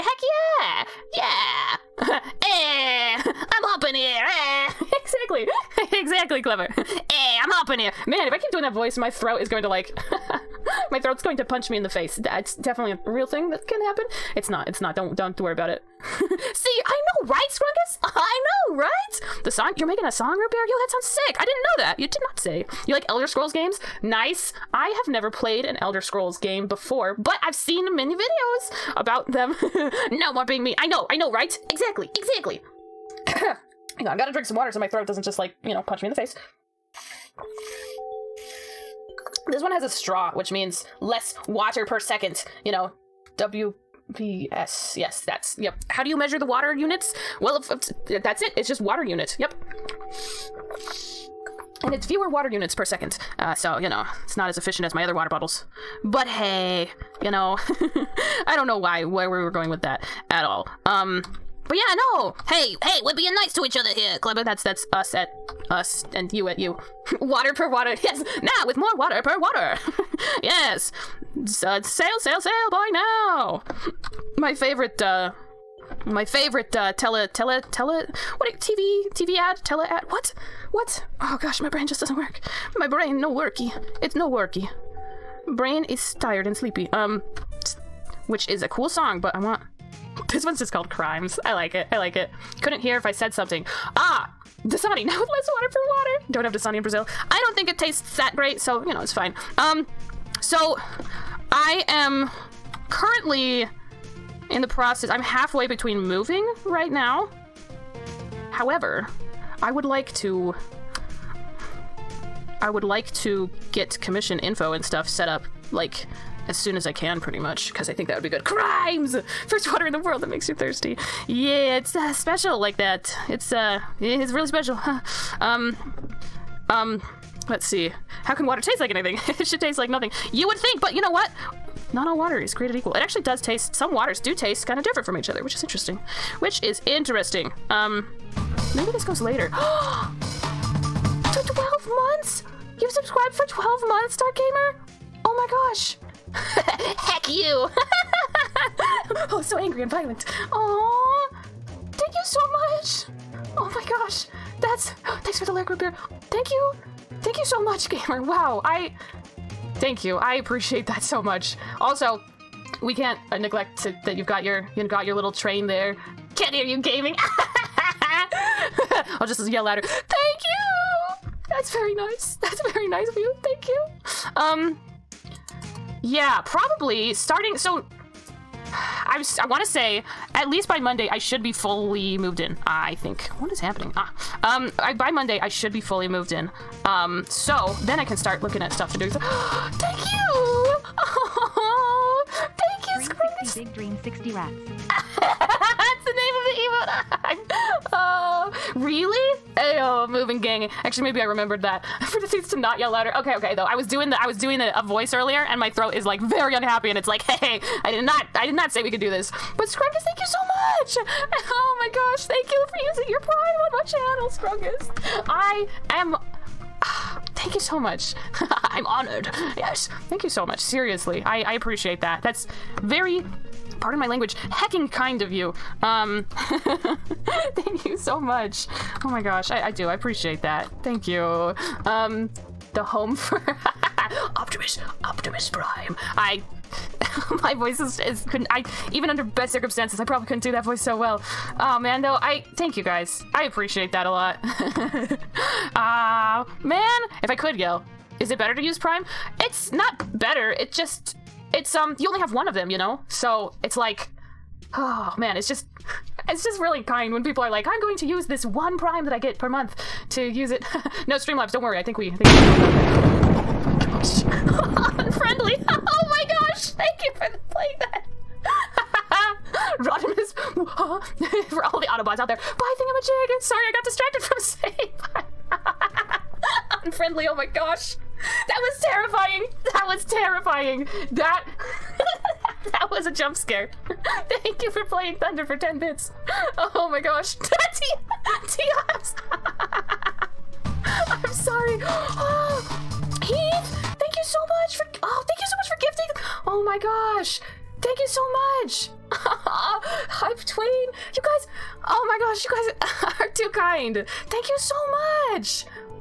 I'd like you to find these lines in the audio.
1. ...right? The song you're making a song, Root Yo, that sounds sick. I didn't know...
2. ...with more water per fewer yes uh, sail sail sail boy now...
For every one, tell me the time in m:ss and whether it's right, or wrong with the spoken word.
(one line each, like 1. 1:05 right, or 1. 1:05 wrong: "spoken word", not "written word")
1. 0:18 right
2. 1:08 wrong: "water", not "fewer".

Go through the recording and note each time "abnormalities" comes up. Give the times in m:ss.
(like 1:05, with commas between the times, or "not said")
not said.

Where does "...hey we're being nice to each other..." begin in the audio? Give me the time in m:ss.
1:02.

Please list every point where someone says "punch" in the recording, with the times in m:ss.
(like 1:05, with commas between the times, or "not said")
0:11, 0:35.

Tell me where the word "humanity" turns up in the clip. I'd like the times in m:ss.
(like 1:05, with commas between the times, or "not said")
not said.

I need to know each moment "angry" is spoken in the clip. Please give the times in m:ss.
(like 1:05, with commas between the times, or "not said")
2:29.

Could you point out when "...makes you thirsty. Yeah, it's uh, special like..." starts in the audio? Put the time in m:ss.
2:00.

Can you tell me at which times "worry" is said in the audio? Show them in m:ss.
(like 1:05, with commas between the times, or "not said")
0:15, 4:21.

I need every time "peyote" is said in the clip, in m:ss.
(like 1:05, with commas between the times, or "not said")
not said.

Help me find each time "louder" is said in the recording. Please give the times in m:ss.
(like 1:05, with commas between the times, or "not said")
2:49, 3:22.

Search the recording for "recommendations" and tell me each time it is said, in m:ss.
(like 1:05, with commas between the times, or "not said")
not said.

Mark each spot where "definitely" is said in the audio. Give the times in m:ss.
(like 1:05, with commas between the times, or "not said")
0:12.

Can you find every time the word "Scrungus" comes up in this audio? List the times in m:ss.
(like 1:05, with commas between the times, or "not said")
0:17, 3:29, 3:34.